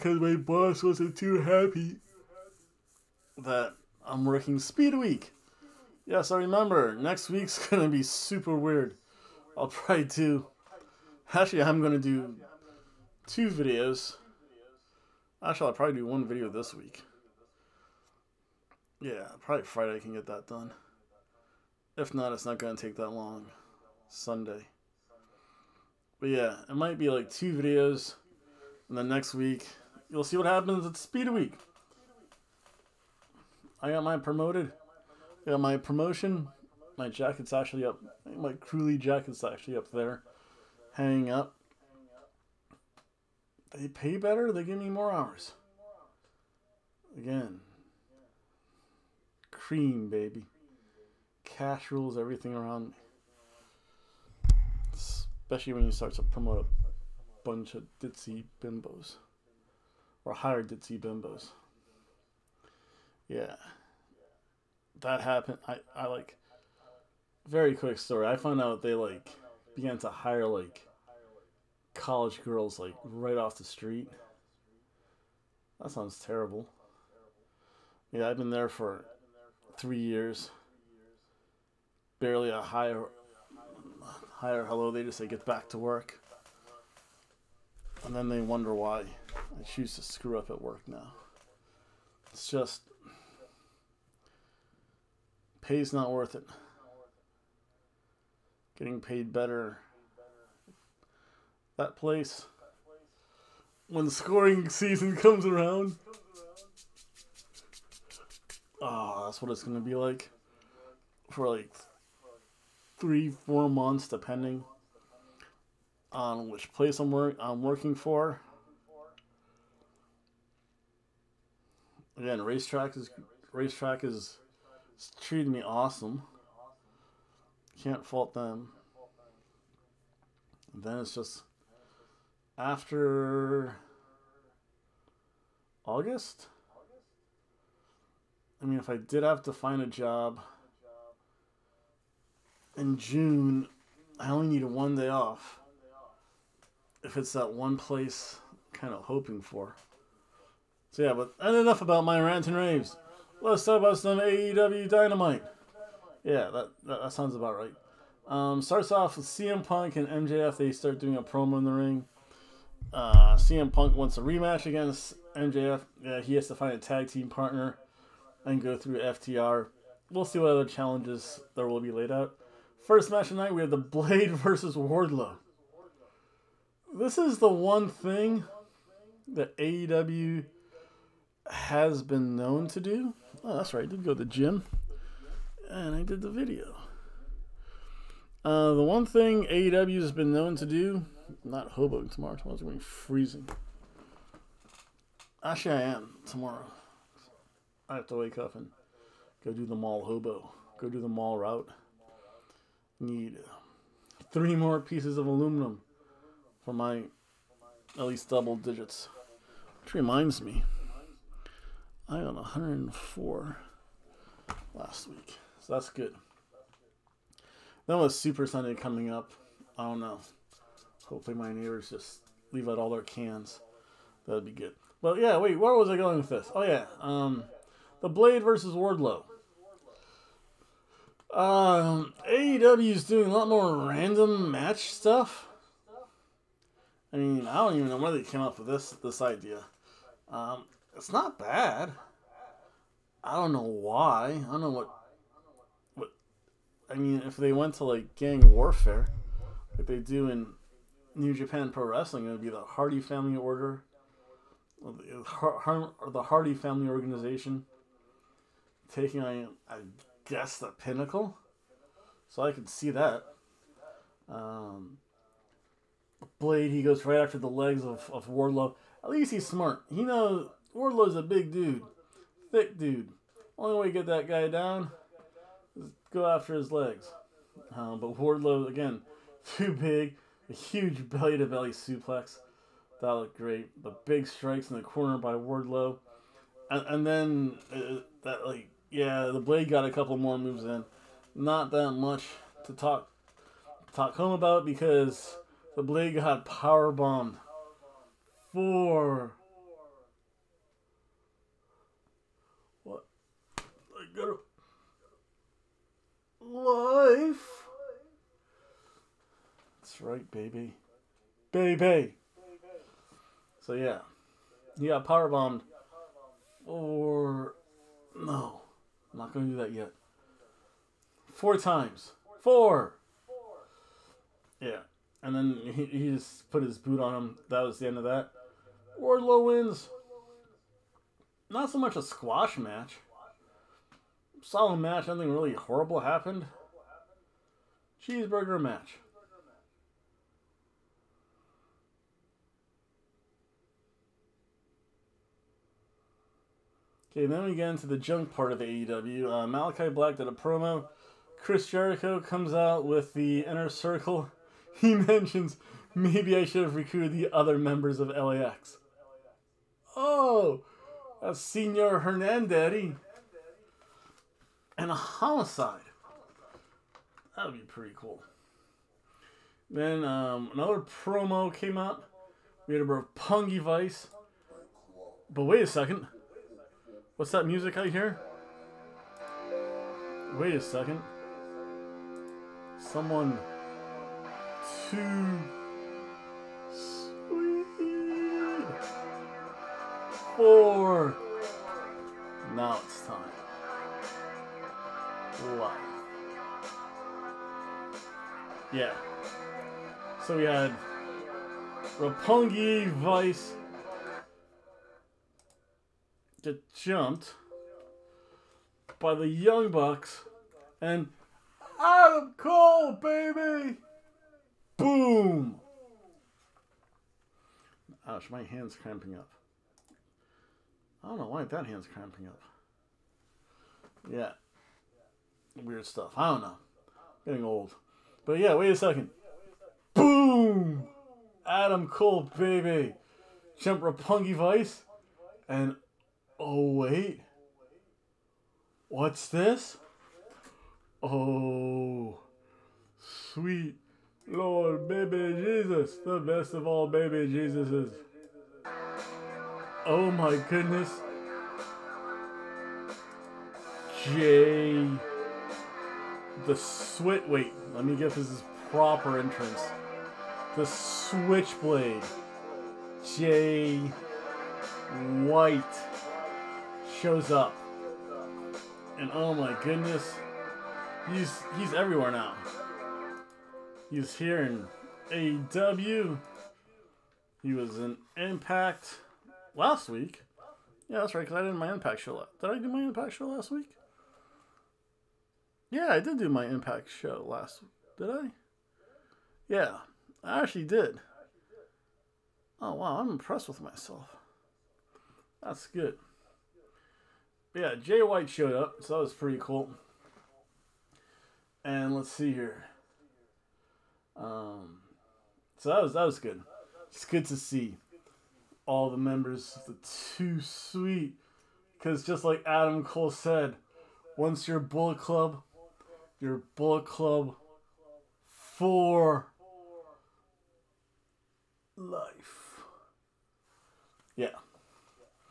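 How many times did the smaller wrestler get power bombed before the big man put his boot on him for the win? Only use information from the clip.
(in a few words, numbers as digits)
4.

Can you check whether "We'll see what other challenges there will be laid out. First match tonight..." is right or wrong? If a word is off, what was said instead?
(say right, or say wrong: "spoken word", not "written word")
right.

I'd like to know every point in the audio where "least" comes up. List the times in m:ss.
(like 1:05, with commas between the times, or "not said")
3:28, 4:29.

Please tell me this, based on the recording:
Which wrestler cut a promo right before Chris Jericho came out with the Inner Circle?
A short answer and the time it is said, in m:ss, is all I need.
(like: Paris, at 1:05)
Malachi Black, at 5:49.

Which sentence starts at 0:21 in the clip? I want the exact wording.
If not, it's not going to take that long.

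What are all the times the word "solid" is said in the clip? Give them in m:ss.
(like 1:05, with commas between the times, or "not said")
5:34.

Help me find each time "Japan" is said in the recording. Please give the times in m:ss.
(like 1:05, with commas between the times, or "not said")
4:11.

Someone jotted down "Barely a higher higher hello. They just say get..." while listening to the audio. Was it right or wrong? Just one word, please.
right.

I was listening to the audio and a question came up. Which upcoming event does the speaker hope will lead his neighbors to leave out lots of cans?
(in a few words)
Super Sunday.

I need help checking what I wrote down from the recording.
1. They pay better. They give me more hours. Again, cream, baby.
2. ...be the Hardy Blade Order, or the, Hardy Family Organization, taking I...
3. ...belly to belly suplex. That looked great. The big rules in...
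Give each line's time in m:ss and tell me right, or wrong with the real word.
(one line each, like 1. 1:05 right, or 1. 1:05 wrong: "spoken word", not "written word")
1. 0:43 right
2. 4:12 wrong: "Family", not "Blade"
3. 4:41 wrong: "strikes", not "rules".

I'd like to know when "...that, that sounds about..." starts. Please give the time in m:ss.
2:36.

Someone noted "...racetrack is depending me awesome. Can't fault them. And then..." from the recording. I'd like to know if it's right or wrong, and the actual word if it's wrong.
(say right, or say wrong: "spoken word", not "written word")
wrong: "treating", not "depending".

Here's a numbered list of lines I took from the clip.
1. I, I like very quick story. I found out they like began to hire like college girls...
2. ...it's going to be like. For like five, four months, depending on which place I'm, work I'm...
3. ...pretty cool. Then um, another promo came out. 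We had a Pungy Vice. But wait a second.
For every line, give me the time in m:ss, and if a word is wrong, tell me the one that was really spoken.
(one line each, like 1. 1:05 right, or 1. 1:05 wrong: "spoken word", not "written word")
1. 1:05 right
2. 1:49 wrong: "three", not "five"
3. 6:07 right.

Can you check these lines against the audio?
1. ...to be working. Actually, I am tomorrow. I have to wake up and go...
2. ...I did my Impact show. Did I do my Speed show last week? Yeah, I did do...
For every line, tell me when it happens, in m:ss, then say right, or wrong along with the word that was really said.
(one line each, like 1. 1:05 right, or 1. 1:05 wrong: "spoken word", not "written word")
1. 3:12 wrong: "freezing", not "working"
2. 8:01 wrong: "Impact", not "Speed".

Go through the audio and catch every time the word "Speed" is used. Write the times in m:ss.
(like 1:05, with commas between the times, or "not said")
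0:04, 0:30.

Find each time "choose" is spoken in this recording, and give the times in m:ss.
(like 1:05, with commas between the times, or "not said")
1:29.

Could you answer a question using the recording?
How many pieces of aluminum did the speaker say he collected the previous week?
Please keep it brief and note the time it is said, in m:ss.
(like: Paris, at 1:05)
104, at 3:32.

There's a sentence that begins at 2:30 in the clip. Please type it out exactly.
So yeah, but enough about my rants and raves.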